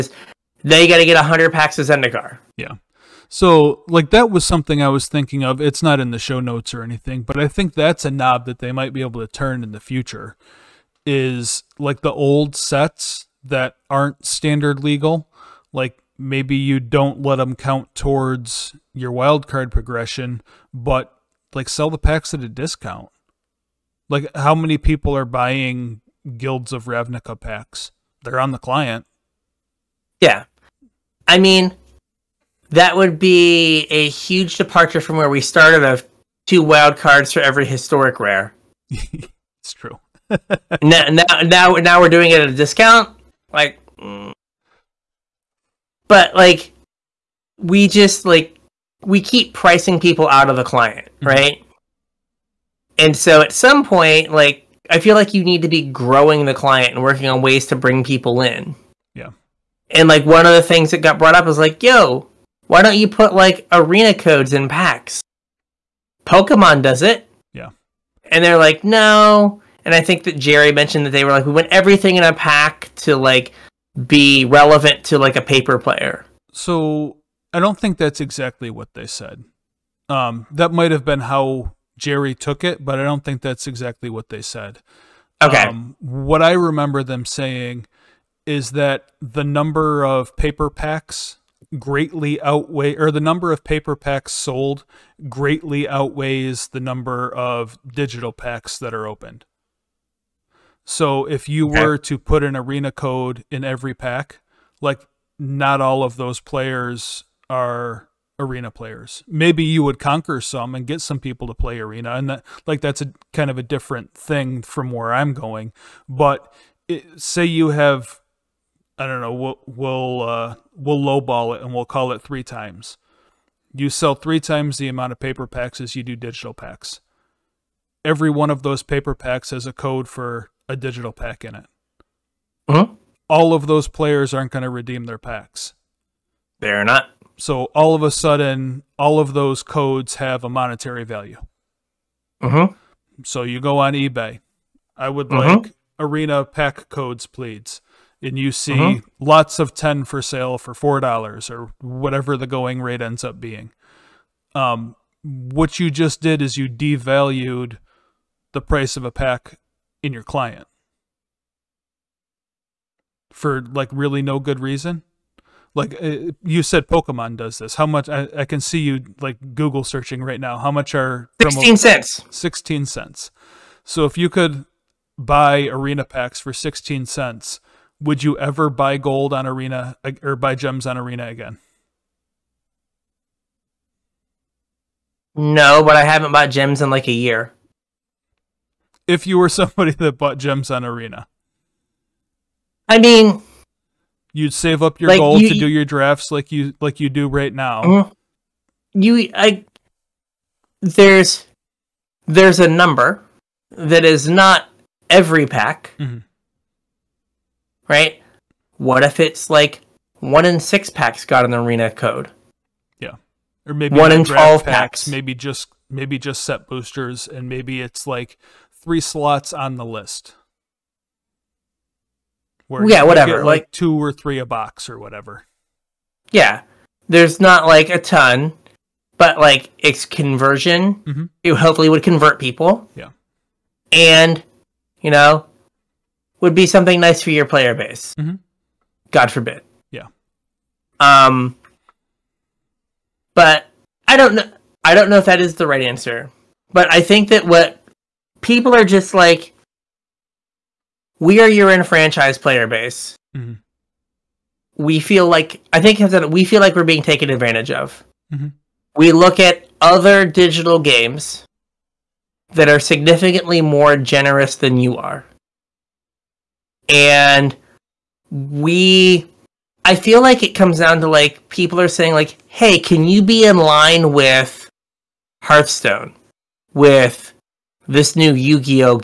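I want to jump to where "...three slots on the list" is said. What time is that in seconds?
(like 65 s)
218 s.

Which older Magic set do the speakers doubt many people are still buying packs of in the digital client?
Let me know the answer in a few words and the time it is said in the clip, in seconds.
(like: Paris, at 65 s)
Guilds of Ravnica, at 26 s.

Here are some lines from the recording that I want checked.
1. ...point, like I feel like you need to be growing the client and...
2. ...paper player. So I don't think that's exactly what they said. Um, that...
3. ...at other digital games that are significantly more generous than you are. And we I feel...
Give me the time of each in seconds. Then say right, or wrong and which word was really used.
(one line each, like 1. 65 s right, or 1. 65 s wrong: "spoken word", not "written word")
1. 53 s right
2. 75 s right
3. 259 s right.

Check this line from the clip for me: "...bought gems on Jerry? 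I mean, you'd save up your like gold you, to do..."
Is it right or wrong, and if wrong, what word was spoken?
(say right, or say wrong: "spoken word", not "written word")
wrong: "Arena", not "Jerry".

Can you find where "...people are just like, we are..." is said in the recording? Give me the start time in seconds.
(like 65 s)
248 s.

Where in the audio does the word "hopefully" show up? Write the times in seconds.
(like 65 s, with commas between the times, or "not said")
231 s.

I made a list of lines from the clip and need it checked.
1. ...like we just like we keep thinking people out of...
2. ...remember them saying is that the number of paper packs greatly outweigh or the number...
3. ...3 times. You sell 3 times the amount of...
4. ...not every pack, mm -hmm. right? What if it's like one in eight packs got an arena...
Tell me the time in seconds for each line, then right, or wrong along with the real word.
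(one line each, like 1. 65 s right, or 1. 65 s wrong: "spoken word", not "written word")
1. 46 s wrong: "pricing", not "thinking"
2. 86 s right
3. 122 s right
4. 204 s wrong: "six", not "eight".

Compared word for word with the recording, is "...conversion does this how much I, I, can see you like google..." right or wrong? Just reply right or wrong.
wrong.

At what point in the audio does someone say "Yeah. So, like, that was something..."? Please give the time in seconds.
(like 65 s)
2 s.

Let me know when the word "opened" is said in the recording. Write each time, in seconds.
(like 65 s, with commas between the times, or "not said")
99 s.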